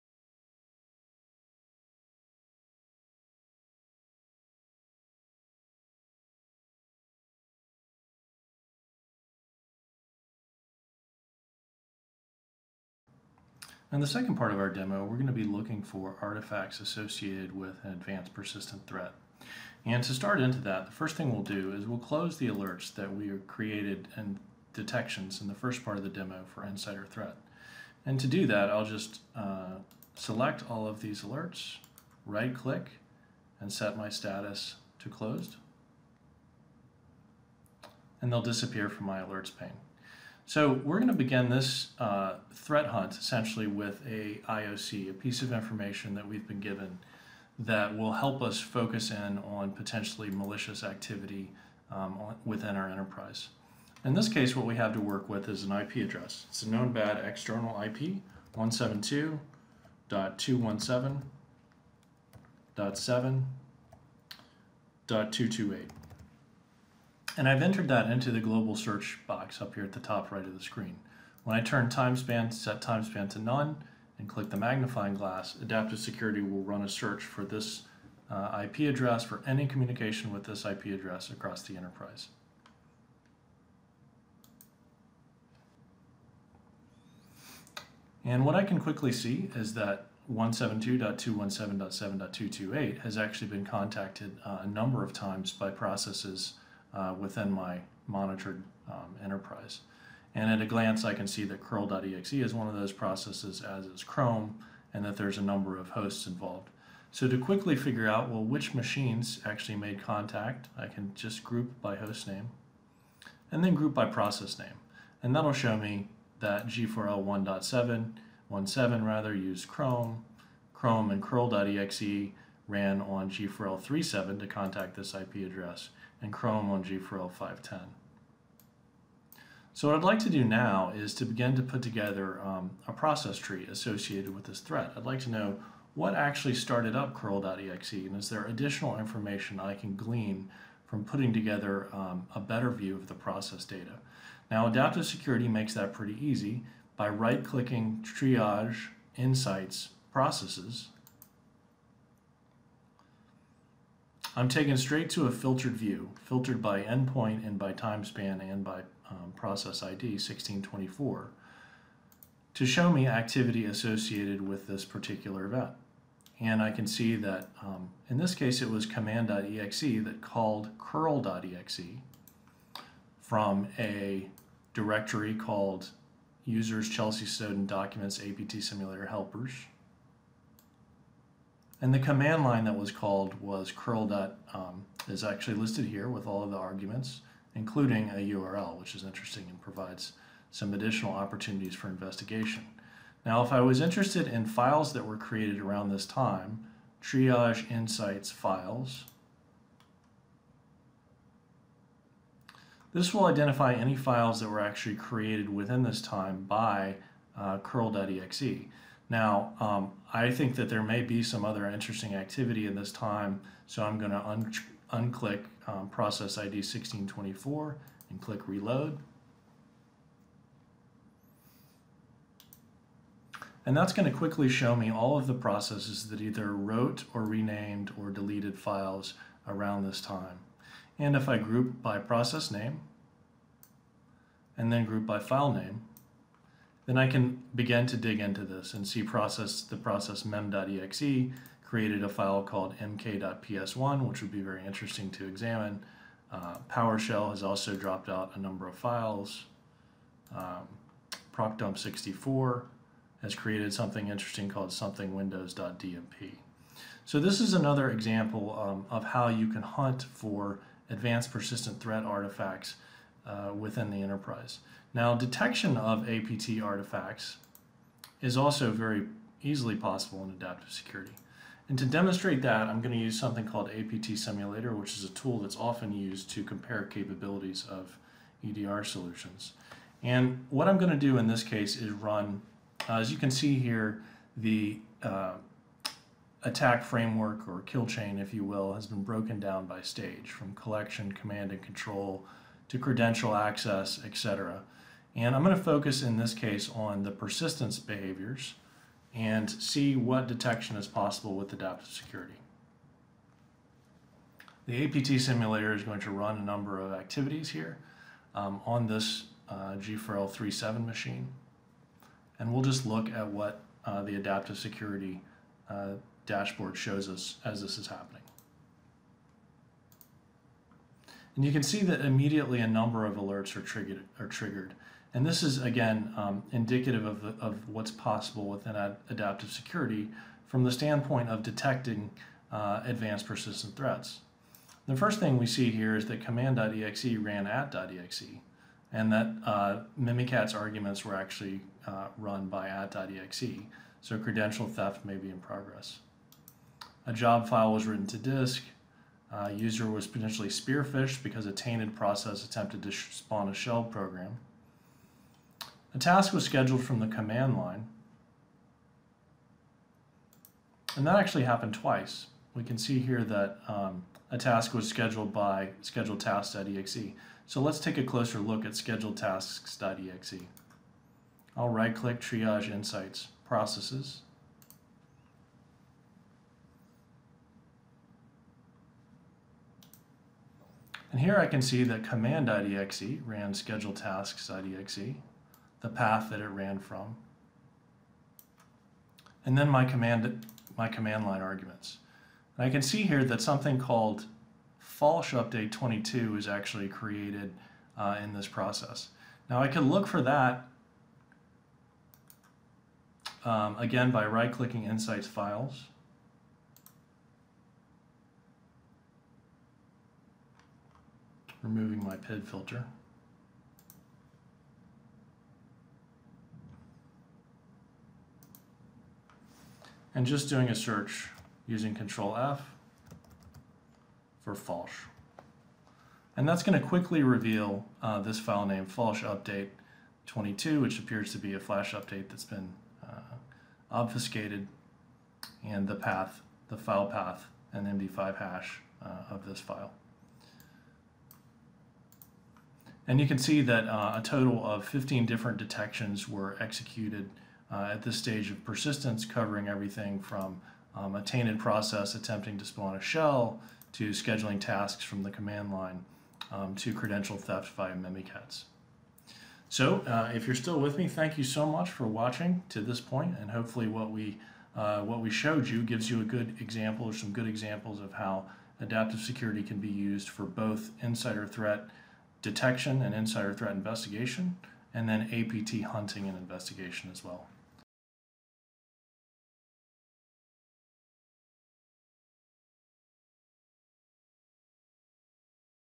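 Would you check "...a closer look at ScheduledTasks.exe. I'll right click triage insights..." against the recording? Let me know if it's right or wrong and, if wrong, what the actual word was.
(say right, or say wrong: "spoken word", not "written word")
right.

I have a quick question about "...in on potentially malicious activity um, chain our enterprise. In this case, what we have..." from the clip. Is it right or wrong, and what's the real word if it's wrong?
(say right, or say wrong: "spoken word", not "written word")
wrong: "within", not "chain".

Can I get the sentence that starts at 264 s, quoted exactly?
Now, detection of APT artifacts is also very easily possible in adaptive security.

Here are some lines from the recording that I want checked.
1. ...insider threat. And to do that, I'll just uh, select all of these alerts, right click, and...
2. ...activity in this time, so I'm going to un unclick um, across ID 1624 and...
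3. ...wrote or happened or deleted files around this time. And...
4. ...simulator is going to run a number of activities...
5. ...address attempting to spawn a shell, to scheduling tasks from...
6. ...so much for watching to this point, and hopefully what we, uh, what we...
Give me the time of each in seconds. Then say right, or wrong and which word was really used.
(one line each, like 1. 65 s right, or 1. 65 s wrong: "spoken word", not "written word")
1. 26 s right
2. 212 s wrong: "process", not "across"
3. 226 s wrong: "renamed", not "happened"
4. 305 s right
5. 451 s wrong: "process", not "address"
6. 461 s right.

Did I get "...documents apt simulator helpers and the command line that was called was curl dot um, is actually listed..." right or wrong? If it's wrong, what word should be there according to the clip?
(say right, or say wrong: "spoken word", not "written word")
right.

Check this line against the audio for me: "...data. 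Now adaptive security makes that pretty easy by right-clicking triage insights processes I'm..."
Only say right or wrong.
right.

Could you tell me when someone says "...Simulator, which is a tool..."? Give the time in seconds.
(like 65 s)
274 s.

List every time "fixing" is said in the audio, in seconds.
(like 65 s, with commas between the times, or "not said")
not said.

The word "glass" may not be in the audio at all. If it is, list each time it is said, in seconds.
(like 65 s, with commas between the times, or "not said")
75 s.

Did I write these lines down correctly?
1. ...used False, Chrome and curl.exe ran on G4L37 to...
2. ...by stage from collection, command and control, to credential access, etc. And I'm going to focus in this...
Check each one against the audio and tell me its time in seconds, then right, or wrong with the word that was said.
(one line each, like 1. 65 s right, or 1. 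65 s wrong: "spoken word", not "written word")
1. 119 s wrong: "Chrome", not "False"
2. 289 s right.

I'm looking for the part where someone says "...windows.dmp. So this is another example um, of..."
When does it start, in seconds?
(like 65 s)
255 s.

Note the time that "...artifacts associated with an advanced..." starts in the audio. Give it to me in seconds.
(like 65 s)
16 s.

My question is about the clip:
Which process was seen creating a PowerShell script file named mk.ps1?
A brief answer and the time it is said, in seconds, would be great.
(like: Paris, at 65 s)
mem.exe, at 239 s.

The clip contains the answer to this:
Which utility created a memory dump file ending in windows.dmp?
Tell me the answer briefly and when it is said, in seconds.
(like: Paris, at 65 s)
ProcDump64, at 251 s.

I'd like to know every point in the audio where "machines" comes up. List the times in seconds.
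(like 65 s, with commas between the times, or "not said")
108 s, 310 s.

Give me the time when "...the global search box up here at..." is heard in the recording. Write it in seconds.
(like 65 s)
68 s.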